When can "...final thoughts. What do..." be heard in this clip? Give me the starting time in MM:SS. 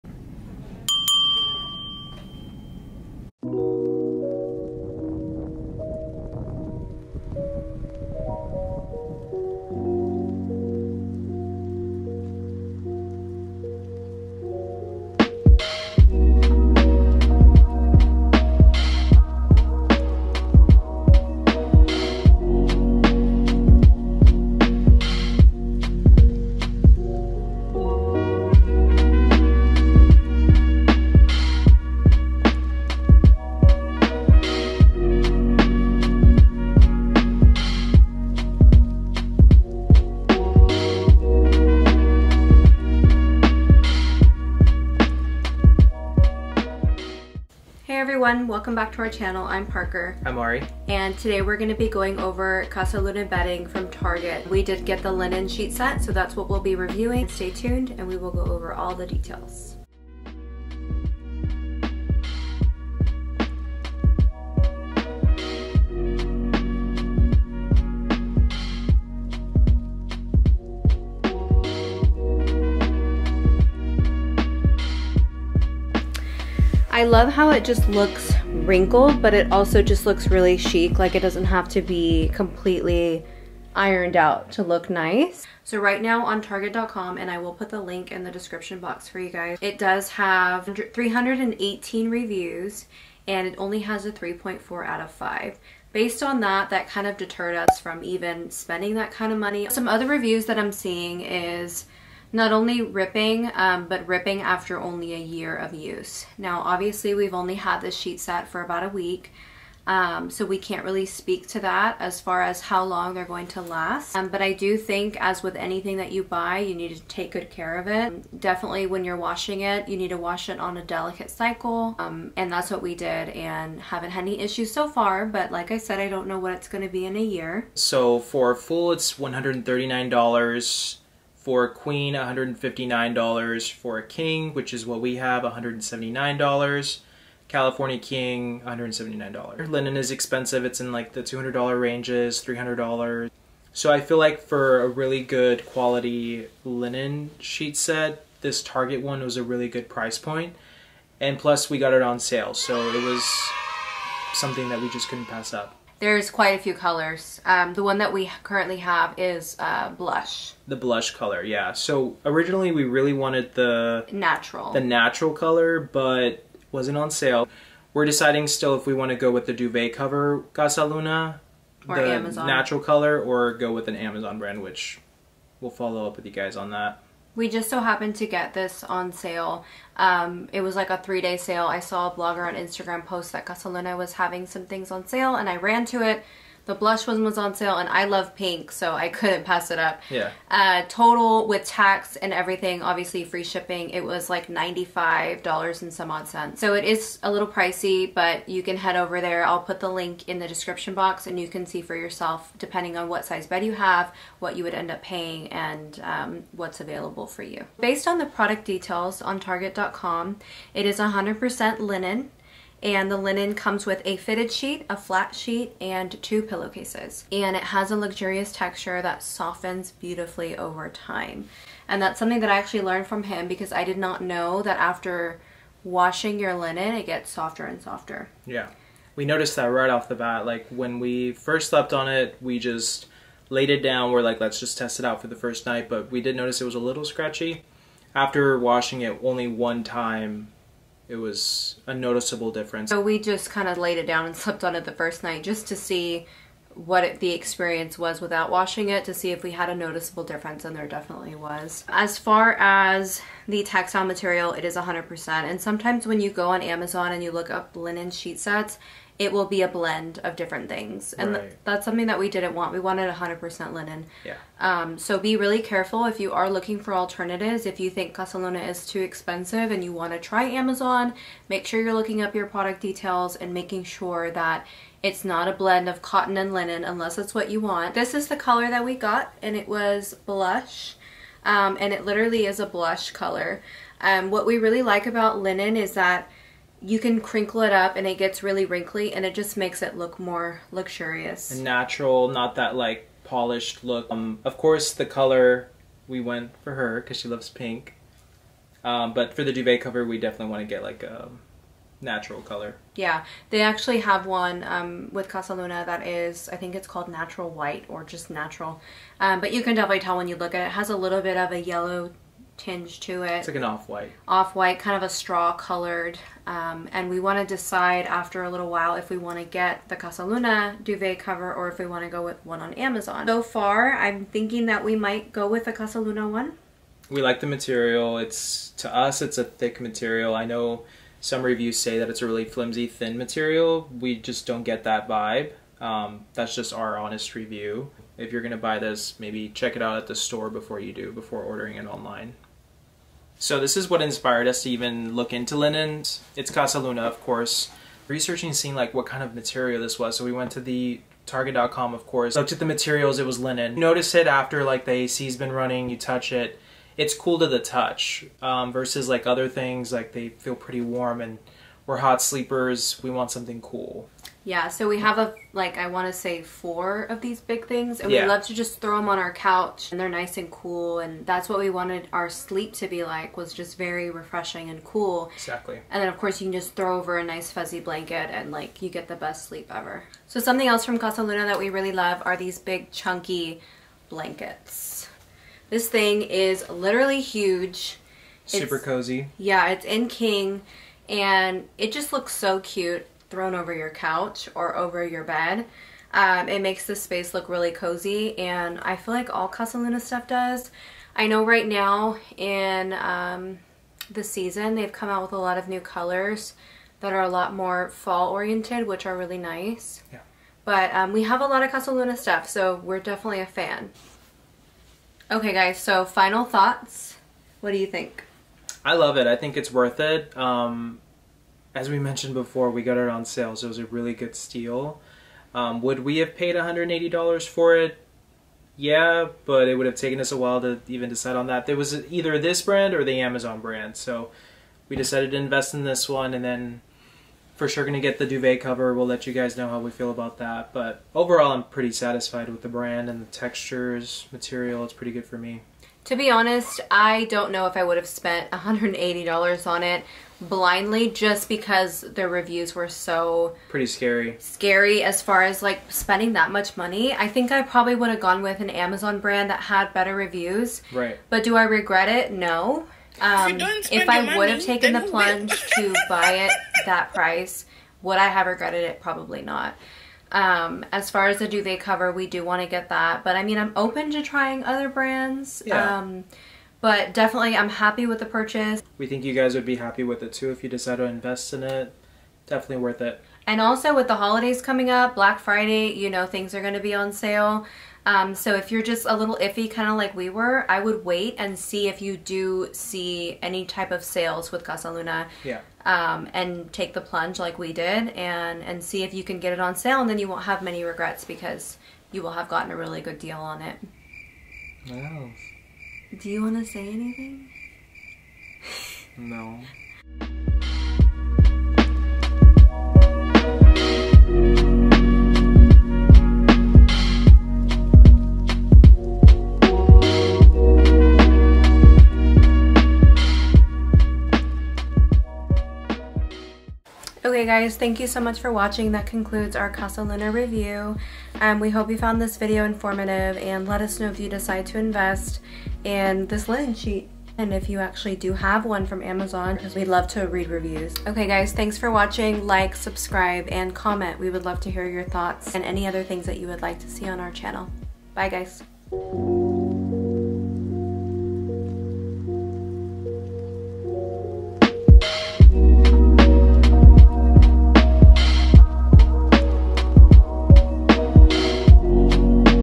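06:56.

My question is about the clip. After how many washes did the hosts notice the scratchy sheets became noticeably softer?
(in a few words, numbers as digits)
1.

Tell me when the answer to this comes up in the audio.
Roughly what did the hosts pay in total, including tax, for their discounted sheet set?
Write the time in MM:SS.
03:14.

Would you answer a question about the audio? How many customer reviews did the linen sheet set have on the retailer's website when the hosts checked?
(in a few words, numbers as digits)
318.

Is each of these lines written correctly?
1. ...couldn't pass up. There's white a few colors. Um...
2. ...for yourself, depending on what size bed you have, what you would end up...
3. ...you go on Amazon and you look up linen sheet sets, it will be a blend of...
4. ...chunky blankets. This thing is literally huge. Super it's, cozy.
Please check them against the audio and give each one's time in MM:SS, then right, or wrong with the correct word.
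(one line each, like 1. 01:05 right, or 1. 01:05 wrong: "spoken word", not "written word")
1. 02:35 wrong: "quite", not "white"
2. 03:21 right
3. 04:16 right
4. 06:22 right.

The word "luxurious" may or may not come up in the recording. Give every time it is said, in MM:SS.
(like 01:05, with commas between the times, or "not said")
03:37, 04:50.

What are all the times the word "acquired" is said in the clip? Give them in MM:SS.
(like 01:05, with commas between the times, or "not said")
not said.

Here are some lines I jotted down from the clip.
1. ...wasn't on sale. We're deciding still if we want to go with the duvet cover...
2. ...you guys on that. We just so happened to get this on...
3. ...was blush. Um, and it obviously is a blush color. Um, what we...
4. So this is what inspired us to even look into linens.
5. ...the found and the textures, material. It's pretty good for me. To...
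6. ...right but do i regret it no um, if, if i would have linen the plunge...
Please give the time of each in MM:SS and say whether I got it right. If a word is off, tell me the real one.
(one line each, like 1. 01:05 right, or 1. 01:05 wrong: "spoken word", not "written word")
1. 02:46 right
2. 02:56 right
3. 04:39 wrong: "literally", not "obviously"
4. 05:43 right
5. 07:22 wrong: "brand", not "found"
6. 07:40 wrong: "taken", not "linen".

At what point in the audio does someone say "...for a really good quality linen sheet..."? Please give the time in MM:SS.
02:24.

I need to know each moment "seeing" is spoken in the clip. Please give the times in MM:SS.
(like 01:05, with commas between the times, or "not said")
01:40, 05:48.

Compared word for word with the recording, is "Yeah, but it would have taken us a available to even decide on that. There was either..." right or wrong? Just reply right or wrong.
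wrong.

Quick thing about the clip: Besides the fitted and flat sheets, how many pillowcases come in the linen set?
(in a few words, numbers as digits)
2.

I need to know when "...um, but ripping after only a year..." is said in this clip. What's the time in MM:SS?
01:43.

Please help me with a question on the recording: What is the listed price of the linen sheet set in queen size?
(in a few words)
$159.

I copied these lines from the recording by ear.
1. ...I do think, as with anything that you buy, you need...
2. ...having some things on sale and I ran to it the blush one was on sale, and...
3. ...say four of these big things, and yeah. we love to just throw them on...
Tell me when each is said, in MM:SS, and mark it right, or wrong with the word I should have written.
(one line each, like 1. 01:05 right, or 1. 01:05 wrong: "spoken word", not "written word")
1. 01:54 right
2. 03:04 right
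3. 06:06 right.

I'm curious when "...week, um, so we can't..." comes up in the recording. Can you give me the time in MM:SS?
01:48.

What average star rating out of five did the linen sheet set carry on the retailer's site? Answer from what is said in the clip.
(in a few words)
3.4.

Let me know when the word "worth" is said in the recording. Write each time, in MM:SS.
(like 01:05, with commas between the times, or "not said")
06:59, 08:02.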